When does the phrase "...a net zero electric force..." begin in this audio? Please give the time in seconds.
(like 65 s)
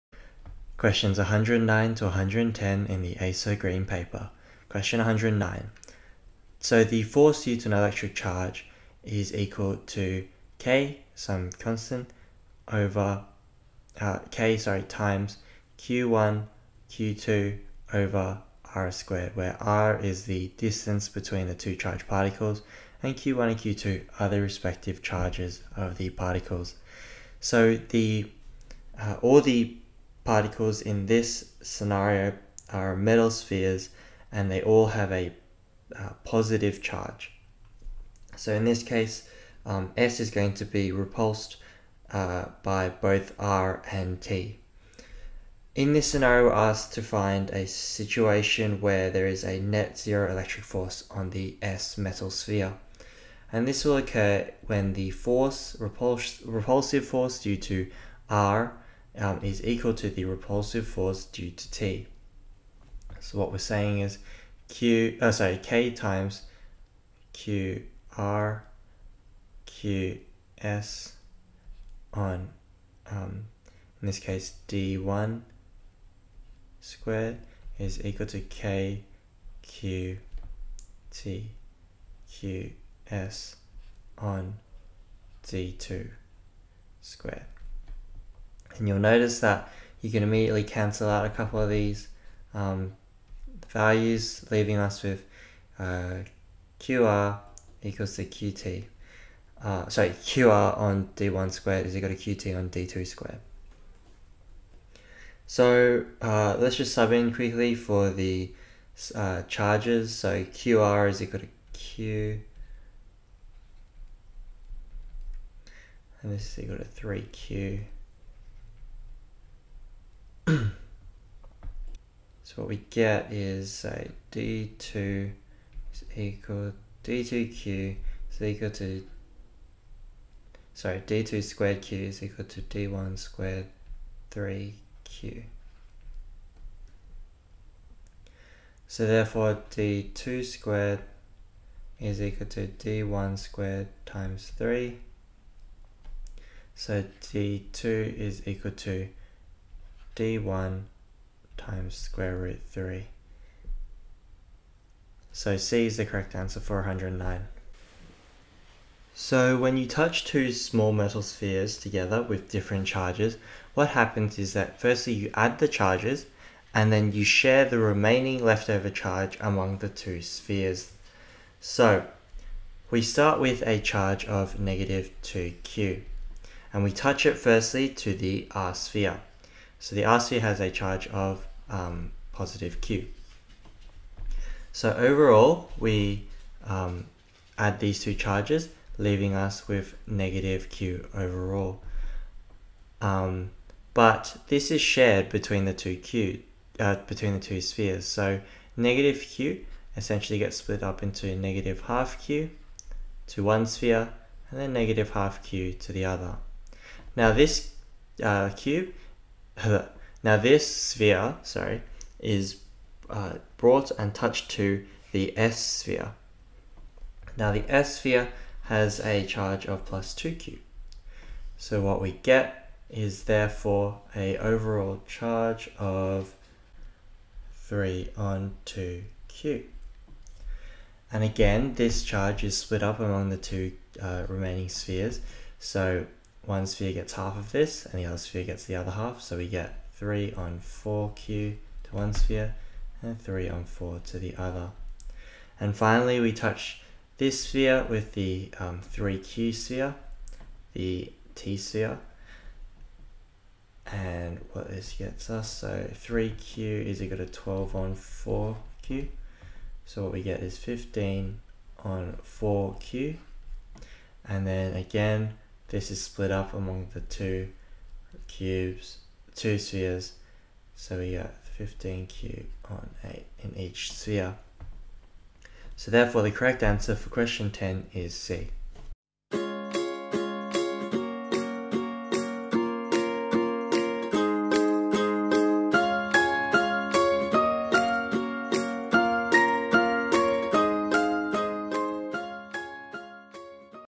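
49 s.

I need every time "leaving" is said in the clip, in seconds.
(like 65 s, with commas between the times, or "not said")
94 s, 188 s.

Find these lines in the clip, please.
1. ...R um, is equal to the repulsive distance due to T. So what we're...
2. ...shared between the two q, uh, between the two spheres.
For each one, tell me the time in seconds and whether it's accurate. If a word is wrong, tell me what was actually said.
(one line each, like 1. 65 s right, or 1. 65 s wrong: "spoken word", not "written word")
1. 58 s wrong: "force", not "distance"
2. 194 s right.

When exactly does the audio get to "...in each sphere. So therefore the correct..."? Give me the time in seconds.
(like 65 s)
273 s.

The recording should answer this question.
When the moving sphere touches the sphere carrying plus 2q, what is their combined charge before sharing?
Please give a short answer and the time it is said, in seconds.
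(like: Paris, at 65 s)
3/2 q, at 227 s.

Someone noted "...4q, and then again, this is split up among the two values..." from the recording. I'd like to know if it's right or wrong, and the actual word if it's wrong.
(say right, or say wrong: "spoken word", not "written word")
wrong: "cubes", not "values".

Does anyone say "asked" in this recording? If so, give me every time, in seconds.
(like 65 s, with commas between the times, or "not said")
46 s.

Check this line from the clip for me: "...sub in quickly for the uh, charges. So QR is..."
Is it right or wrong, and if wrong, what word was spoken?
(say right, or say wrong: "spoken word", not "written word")
right.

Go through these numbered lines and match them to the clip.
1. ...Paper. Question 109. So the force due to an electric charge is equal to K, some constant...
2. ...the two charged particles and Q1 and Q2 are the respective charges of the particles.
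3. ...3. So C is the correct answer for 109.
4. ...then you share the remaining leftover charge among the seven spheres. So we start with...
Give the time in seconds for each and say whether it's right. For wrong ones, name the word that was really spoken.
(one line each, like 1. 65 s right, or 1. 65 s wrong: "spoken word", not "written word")
1. 3 s right
2. 21 s right
3. 152 s right
4. 166 s wrong: "two", not "seven".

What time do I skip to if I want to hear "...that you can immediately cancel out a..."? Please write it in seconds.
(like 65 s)
89 s.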